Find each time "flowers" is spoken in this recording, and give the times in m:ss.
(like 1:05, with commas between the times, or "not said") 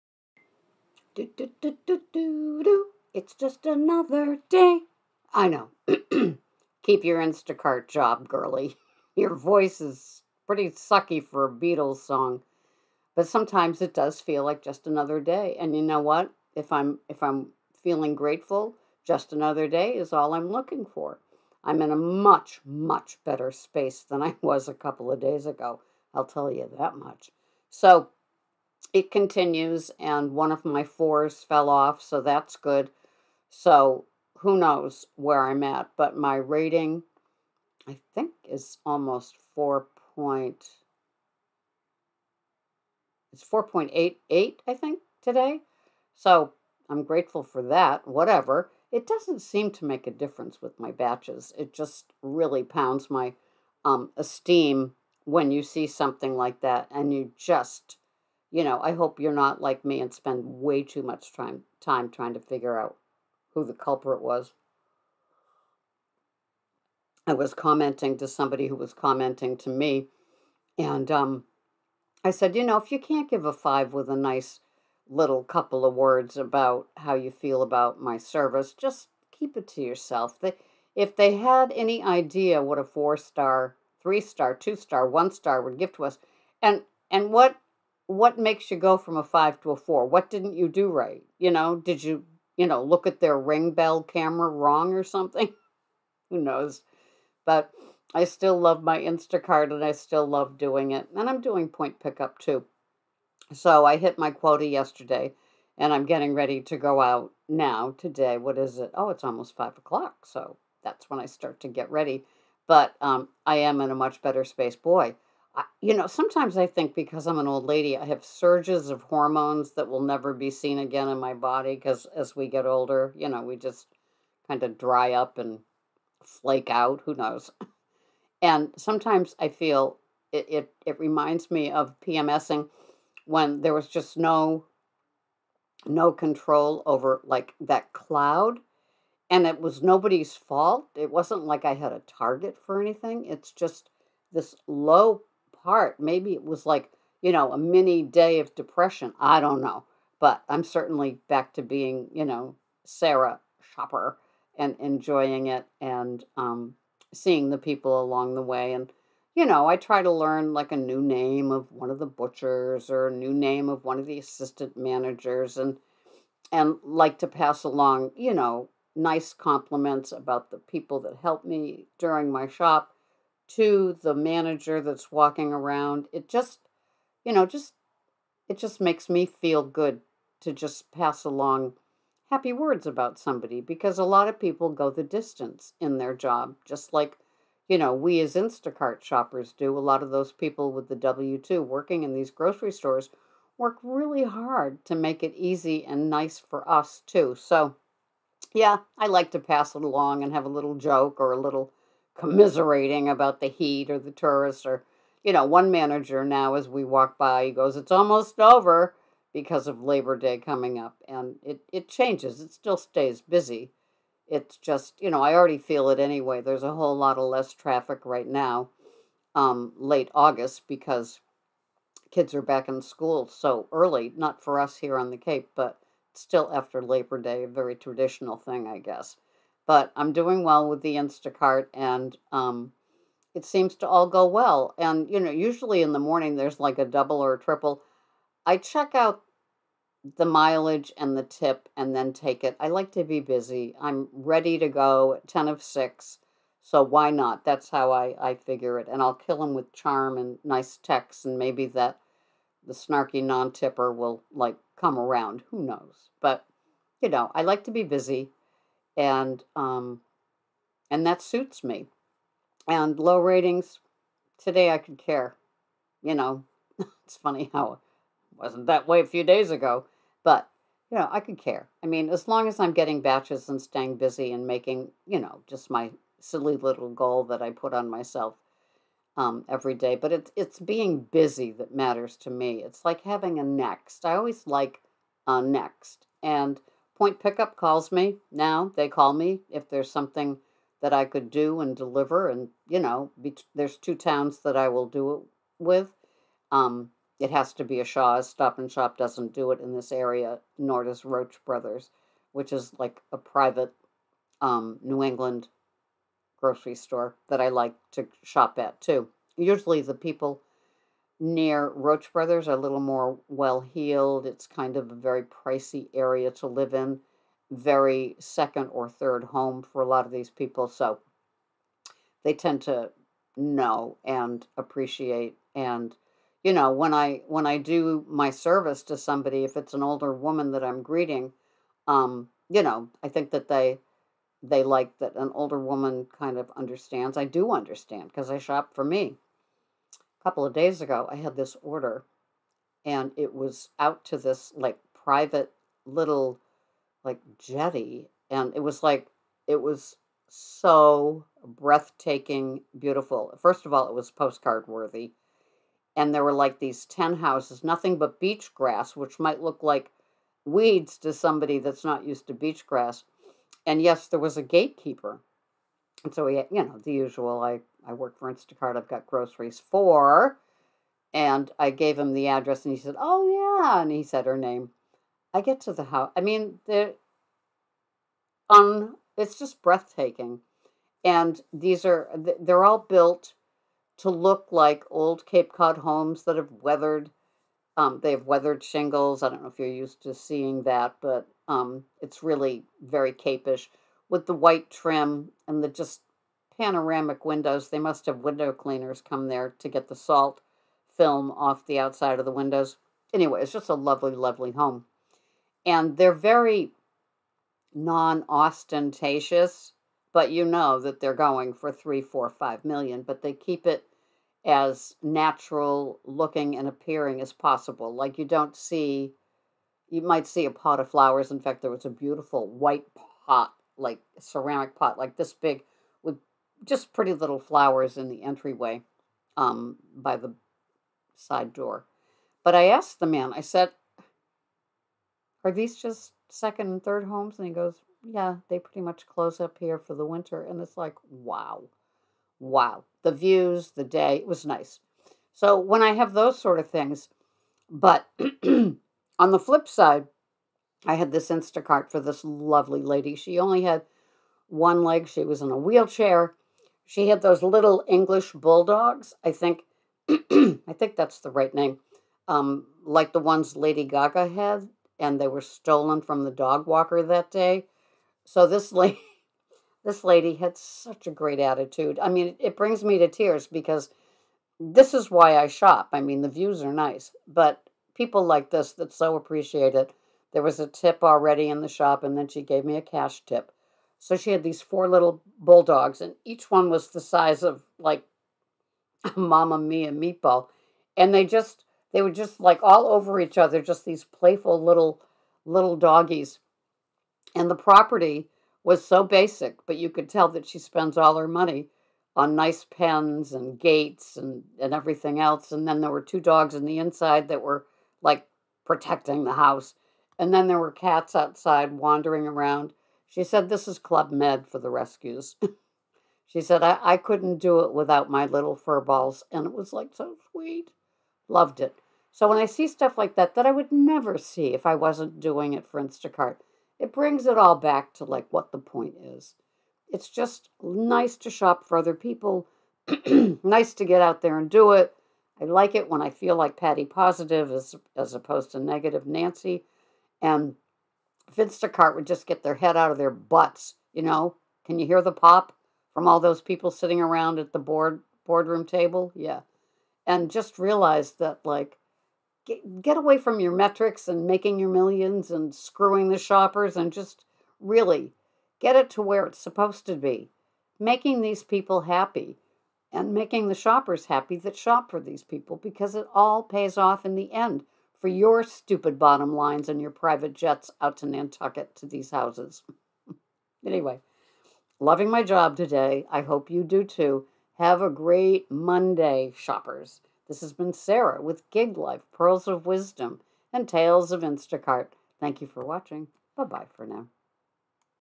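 7:00, 7:07.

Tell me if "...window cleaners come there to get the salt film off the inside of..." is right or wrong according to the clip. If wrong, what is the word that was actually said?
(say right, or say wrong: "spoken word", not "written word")
wrong: "outside", not "inside".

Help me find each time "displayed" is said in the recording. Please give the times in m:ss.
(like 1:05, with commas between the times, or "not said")
not said.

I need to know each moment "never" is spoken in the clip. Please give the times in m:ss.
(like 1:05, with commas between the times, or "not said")
2:00, 8:43.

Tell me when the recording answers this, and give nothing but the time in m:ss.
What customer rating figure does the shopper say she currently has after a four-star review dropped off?
0:43.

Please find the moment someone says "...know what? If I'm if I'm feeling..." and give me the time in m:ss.
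0:15.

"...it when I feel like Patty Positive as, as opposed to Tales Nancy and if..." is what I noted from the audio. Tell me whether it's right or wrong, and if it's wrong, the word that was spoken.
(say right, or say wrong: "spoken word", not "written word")
wrong: "Negative", not "Tales".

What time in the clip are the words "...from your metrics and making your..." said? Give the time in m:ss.
9:13.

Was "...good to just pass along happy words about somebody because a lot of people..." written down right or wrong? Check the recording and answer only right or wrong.
right.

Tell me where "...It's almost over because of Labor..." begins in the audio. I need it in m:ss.
3:27.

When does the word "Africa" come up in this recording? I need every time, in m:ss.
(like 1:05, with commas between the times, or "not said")
not said.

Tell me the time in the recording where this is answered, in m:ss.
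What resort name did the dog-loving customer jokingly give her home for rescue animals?
8:33.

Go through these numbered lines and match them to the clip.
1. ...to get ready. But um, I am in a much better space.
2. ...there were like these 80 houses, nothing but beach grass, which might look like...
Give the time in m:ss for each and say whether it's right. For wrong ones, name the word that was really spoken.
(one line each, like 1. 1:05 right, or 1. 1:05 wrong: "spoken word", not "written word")
1. 1:51 right
2. 5:56 wrong: "10", not "80".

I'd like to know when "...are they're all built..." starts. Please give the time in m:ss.
6:21.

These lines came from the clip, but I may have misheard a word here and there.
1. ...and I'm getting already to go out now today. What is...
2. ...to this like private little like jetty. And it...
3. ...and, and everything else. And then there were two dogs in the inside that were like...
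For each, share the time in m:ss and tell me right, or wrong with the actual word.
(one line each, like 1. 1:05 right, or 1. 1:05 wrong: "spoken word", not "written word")
1. 1:45 wrong: "ready", not "already"
2. 5:44 right
3. 8:24 right.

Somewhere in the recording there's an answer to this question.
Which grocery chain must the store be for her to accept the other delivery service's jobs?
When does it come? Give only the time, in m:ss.
4:57.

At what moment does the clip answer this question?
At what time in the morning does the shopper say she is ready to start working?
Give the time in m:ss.
4:05.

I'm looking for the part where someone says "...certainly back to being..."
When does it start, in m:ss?
2:30.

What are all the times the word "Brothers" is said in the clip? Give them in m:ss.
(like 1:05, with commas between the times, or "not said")
5:01, 5:12.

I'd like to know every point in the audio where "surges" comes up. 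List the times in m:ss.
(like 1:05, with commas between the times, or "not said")
1:58.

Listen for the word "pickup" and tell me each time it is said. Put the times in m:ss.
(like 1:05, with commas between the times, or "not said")
1:41, 4:47.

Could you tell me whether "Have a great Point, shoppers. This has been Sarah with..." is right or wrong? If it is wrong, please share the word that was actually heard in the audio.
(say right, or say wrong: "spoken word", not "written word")
wrong: "Monday", not "Point".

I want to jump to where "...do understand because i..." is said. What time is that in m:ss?
5:37.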